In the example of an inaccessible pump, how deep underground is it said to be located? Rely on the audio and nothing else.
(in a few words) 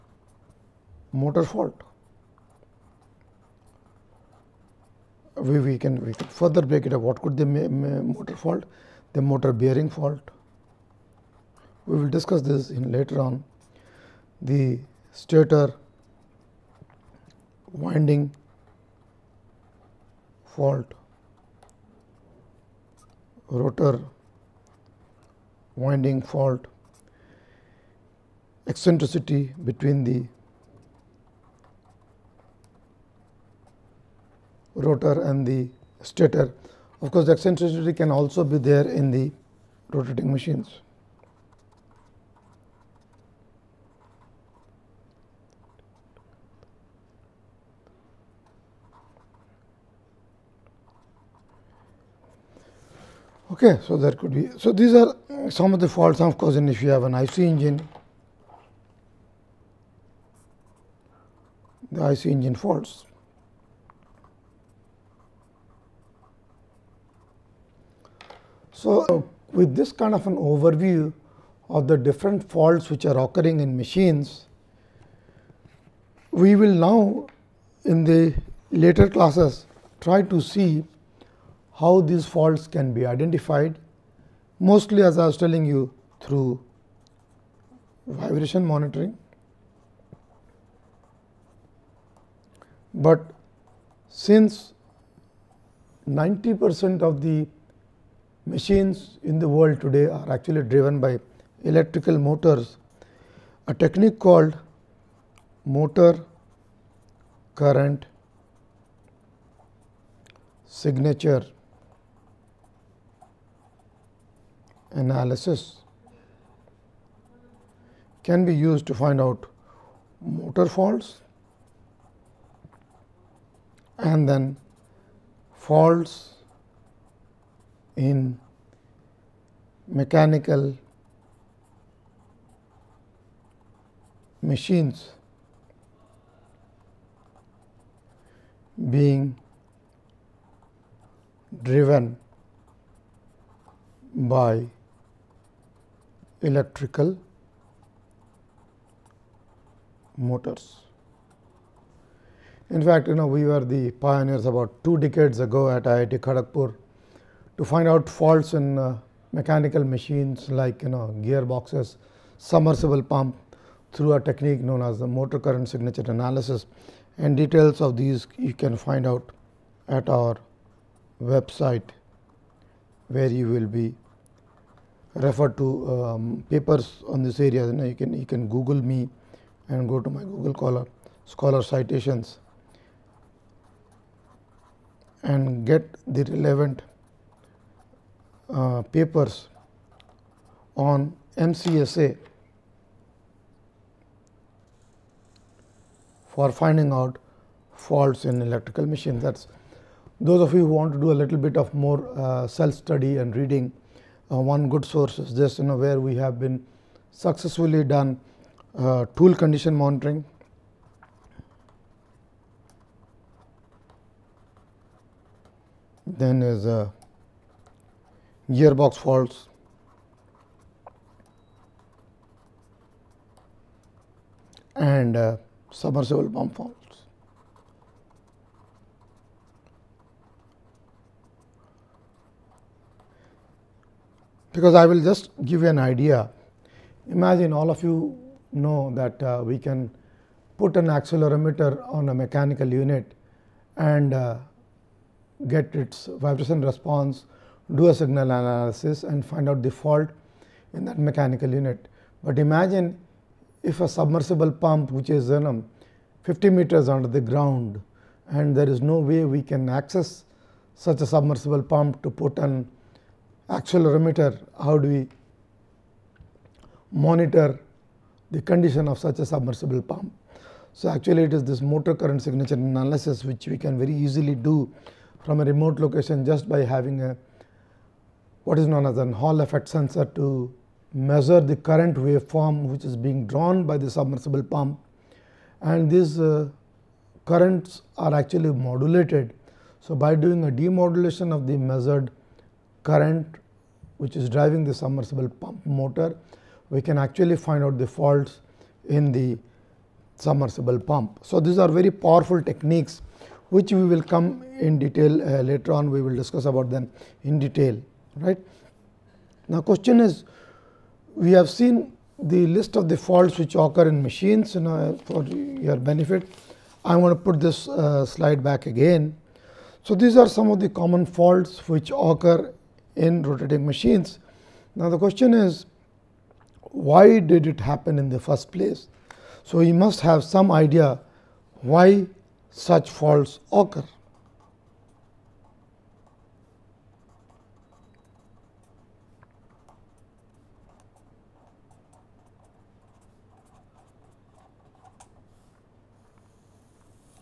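50 meters.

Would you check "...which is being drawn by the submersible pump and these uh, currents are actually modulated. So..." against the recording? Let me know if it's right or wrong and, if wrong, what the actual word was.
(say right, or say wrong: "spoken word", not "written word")
right.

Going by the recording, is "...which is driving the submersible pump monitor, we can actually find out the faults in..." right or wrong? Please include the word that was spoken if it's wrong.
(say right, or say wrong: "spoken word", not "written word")
wrong: "motor", not "monitor".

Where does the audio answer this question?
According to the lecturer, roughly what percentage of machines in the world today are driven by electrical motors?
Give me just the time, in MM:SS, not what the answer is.
01:36.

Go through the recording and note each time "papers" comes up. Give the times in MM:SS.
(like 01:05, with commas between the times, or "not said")
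02:56, 03:08.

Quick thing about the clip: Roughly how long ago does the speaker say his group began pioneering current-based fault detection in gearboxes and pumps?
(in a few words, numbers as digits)
two decades.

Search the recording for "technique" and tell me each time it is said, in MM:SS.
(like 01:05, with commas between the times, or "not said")
01:43, 02:44, 05:02.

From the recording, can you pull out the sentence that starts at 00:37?
Of course, the eccentricity can also be there in the rotating machines.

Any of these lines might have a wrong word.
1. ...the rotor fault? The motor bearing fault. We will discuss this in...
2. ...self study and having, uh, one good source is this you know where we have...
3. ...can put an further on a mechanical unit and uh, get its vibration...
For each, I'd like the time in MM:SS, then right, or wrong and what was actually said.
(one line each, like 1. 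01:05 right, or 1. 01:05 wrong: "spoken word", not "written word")
1. 00:07 wrong: "motor", not "rotor"
2. 03:22 wrong: "reading", not "having"
3. 03:59 wrong: "accelerometer", not "further".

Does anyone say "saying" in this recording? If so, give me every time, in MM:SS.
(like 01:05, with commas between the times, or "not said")
not said.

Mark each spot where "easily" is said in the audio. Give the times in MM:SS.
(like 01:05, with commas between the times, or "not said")
04:33.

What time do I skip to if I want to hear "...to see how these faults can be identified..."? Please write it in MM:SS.
01:20.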